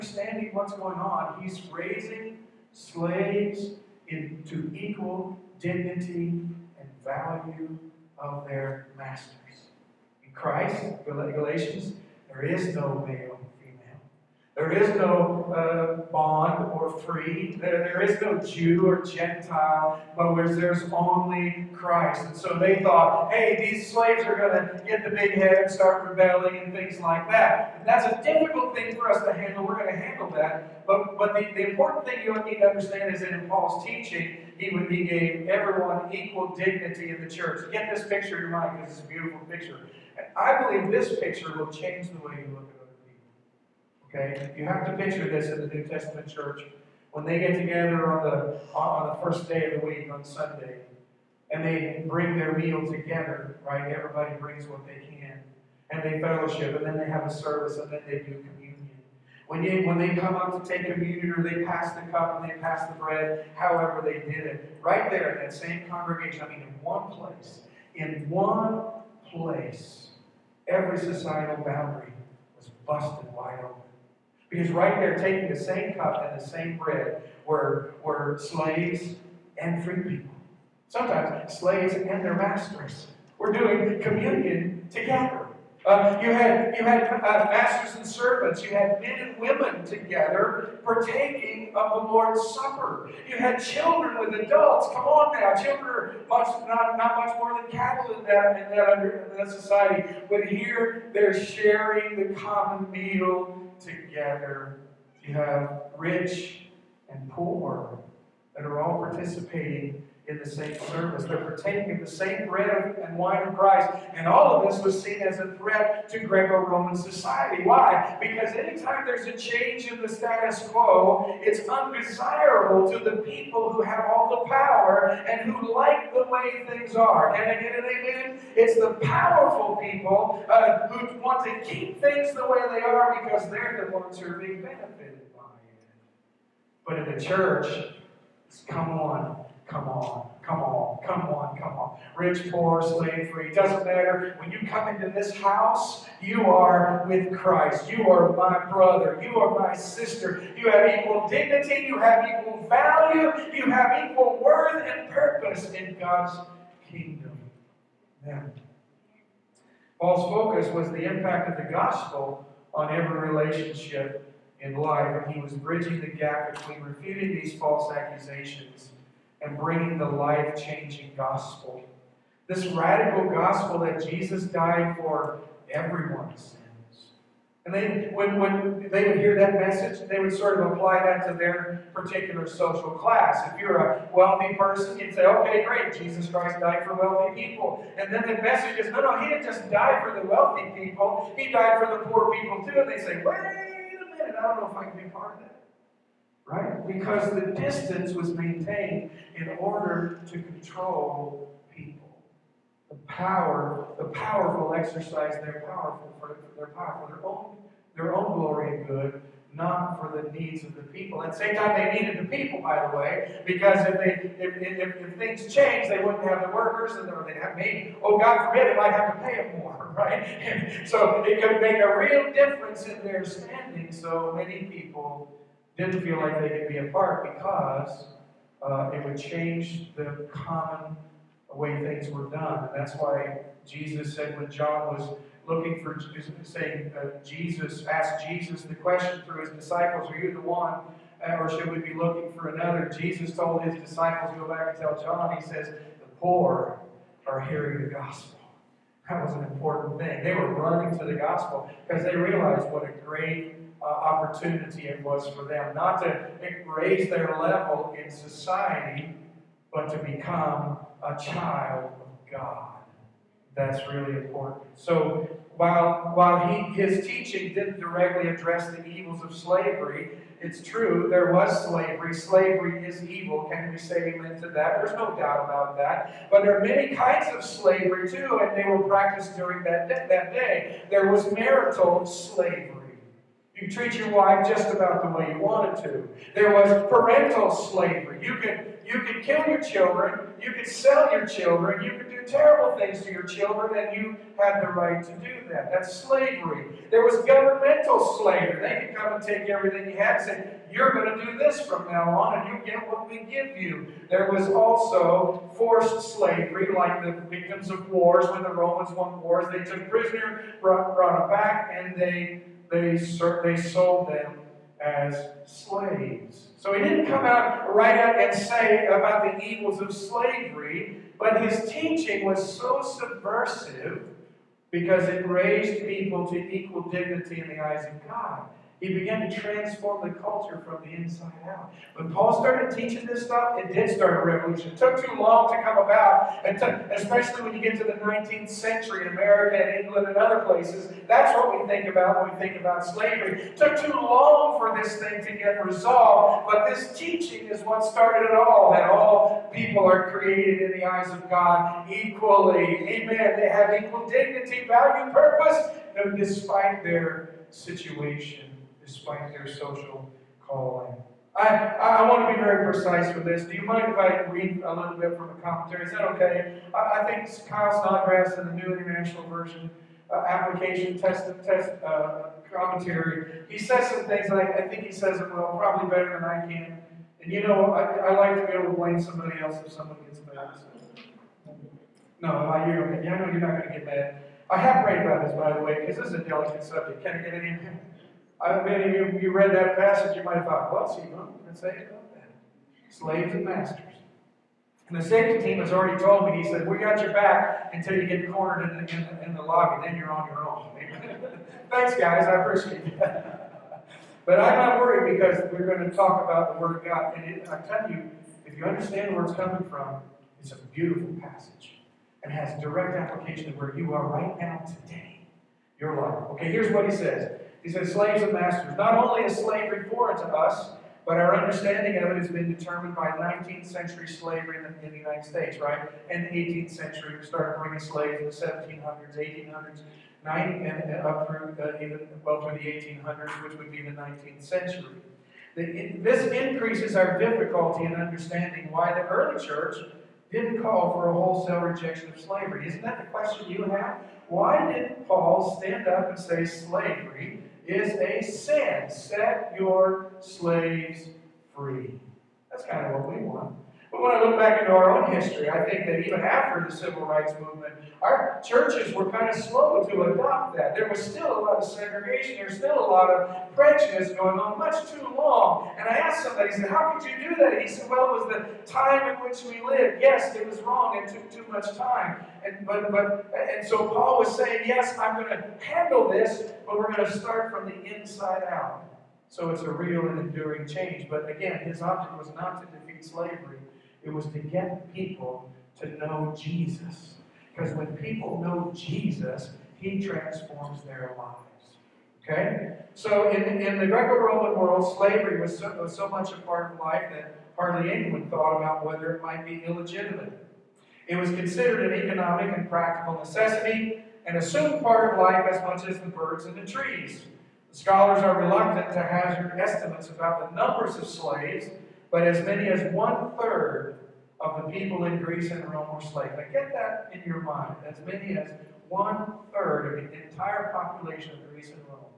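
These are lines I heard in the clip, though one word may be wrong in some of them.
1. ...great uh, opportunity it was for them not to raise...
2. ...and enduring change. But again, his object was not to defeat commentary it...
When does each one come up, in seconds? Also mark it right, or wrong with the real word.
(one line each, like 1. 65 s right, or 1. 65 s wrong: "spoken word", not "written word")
1. 253 s right
2. 480 s wrong: "slavery", not "commentary".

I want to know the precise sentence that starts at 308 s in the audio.
When the Romans won wars, they took prisoner, brought, brought back, and they they, they sold them as slaves.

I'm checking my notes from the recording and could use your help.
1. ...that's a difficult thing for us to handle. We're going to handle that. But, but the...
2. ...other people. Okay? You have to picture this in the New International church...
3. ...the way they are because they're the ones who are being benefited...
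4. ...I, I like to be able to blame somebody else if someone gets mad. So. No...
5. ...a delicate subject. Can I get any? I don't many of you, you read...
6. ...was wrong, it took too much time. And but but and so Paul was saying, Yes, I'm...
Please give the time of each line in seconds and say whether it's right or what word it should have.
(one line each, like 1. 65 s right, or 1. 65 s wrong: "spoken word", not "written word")
1. 27 s right
2. 42 s wrong: "Testament", not "International"
3. 132 s right
4. 377 s right
5. 386 s right
6. 470 s right.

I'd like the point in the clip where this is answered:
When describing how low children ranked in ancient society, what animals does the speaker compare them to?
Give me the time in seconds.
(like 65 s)
97 s.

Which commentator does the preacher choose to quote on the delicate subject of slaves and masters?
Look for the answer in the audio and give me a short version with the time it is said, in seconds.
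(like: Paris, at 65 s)
Klyne Snodgrass, at 367 s.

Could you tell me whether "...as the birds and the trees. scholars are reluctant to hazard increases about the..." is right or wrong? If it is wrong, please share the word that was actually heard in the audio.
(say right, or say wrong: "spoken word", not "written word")
wrong: "estimates", not "increases".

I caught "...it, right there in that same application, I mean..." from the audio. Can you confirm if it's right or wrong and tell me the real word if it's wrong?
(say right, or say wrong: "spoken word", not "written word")
wrong: "congregation", not "application".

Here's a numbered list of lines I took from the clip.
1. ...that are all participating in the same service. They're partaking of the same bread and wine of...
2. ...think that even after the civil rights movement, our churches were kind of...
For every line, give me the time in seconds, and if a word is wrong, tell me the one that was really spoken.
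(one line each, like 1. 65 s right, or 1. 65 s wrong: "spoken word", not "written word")
1. 108 s right
2. 455 s right.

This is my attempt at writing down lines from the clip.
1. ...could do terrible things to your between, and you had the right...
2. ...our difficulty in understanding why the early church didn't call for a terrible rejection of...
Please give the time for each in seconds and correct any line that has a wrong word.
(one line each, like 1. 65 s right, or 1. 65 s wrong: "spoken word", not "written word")
1. 291 s wrong: "children", not "between"
2. 436 s wrong: "wholesale", not "terrible".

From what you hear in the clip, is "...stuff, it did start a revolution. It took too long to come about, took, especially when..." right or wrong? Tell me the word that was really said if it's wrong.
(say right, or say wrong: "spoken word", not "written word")
right.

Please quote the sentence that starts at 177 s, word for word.
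And then when, when they would hear that message, they would sort of apply that to their particular social class.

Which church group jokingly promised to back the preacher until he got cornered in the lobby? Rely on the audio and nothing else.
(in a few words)
The safety team.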